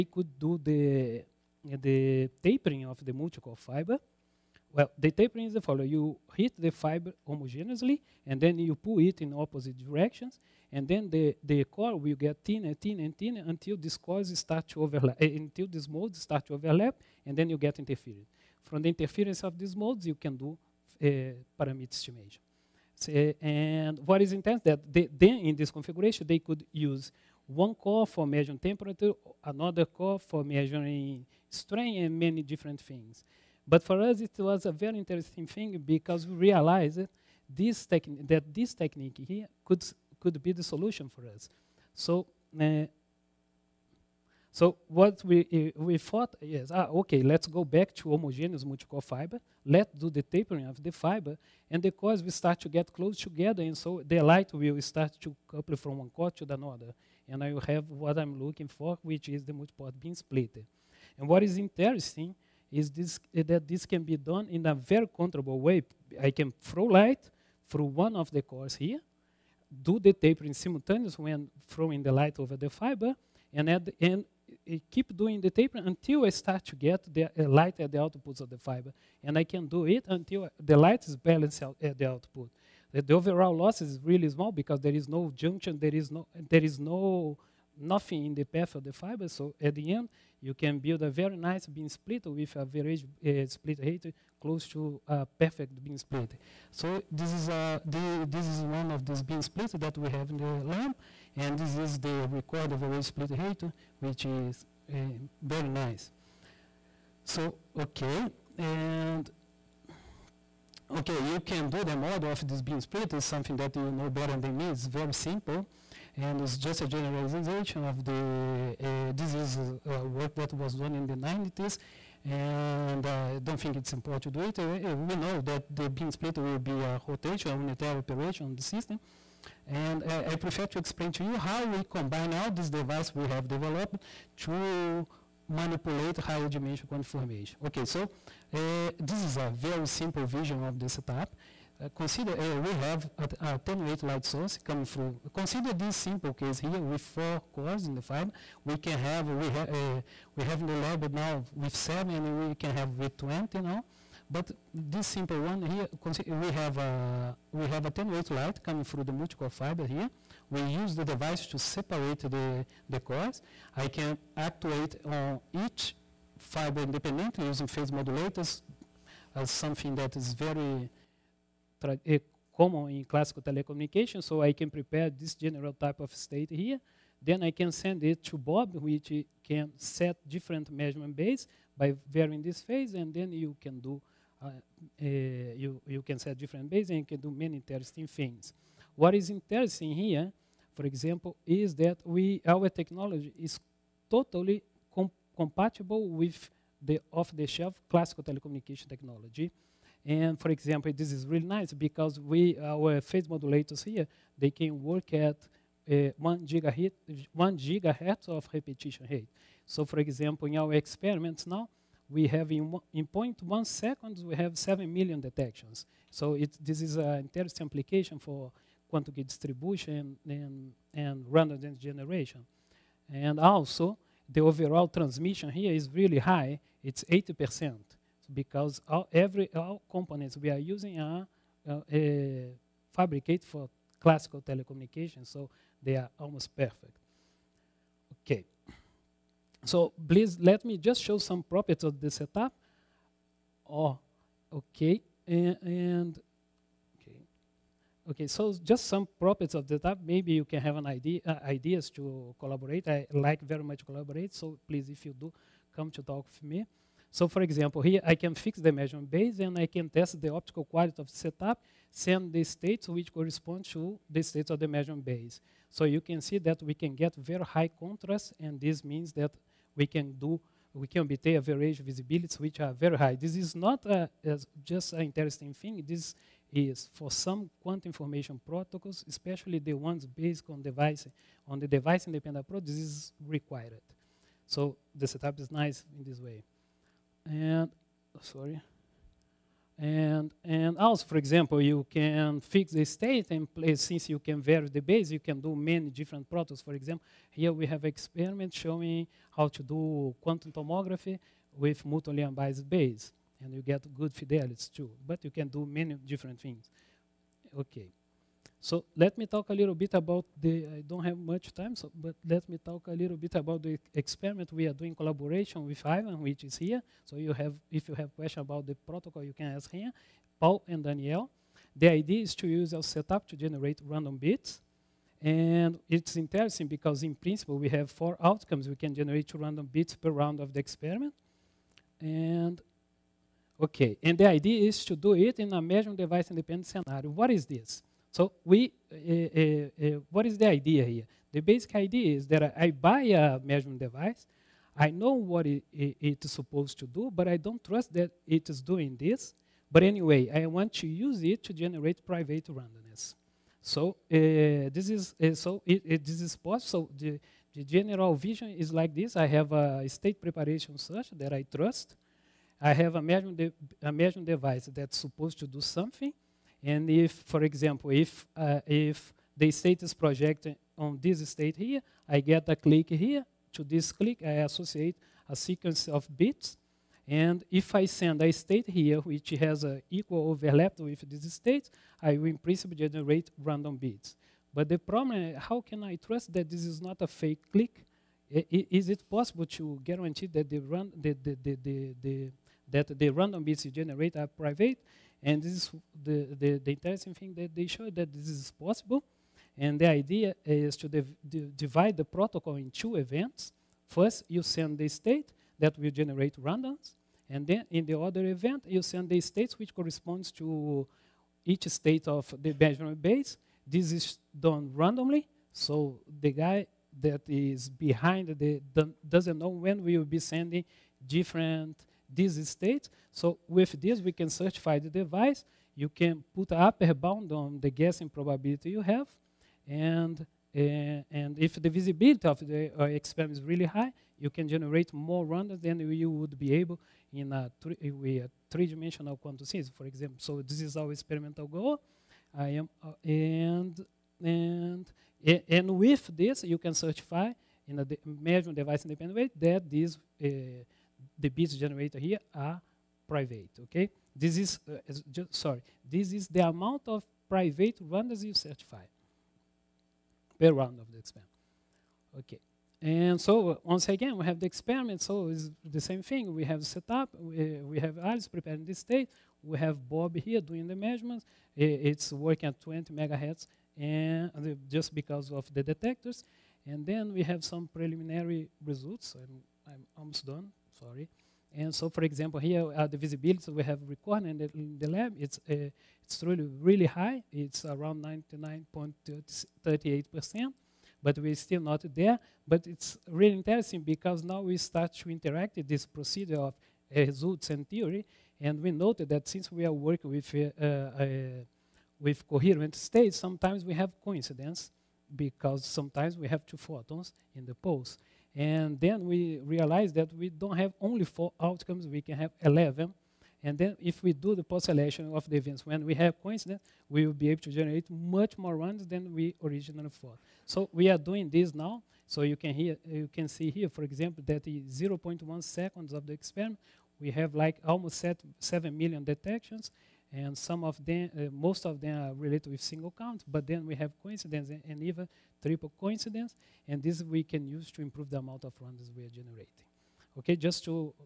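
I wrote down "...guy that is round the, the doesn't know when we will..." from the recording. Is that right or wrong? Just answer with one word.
wrong.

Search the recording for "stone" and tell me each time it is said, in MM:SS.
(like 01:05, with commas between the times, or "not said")
not said.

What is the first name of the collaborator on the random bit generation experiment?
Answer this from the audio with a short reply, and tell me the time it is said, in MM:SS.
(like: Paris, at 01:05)
Ivan, at 05:15.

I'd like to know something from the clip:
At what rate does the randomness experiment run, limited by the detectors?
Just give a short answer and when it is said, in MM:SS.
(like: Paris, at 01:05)
20 megahertz, at 07:52.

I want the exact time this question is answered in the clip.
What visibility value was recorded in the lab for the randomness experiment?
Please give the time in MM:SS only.
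08:08.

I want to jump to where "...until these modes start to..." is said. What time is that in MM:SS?
00:15.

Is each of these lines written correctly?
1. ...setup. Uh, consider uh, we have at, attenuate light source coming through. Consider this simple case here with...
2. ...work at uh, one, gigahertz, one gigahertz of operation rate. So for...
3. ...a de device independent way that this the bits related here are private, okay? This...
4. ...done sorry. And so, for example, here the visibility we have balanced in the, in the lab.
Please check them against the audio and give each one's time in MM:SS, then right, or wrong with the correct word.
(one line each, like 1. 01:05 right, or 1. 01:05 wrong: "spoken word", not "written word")
1. 02:20 right
2. 03:24 wrong: "repetition", not "operation"
3. 07:27 wrong: "generated", not "related"
4. 08:00 wrong: "recorded", not "balanced".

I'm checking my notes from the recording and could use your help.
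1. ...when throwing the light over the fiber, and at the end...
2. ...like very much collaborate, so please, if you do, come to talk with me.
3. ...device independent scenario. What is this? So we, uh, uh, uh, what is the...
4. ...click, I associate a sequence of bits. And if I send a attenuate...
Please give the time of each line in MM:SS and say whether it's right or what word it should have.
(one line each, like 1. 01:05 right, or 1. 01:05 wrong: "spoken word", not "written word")
1. 01:11 right
2. 04:13 right
3. 05:35 right
4. 06:13 wrong: "state", not "attenuate".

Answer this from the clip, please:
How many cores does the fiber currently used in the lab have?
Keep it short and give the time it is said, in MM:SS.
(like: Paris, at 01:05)
7, at 02:31.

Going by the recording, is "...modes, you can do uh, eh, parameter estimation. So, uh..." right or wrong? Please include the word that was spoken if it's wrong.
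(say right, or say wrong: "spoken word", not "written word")
right.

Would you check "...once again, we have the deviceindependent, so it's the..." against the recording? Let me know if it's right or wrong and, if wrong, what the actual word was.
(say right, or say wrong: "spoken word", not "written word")
wrong: "experiment", not "deviceindependent".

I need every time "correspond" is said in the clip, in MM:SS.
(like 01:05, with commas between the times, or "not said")
04:23, 06:49.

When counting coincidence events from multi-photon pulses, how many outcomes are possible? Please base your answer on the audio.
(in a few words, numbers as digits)
11.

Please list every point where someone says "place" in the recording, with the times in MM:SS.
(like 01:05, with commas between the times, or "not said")
04:53.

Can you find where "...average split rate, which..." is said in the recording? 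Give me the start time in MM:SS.
01:42.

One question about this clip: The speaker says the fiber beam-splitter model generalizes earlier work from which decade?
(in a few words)
the 90s.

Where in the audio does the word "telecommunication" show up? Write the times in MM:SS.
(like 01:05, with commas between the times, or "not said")
02:53, 03:18, 03:54.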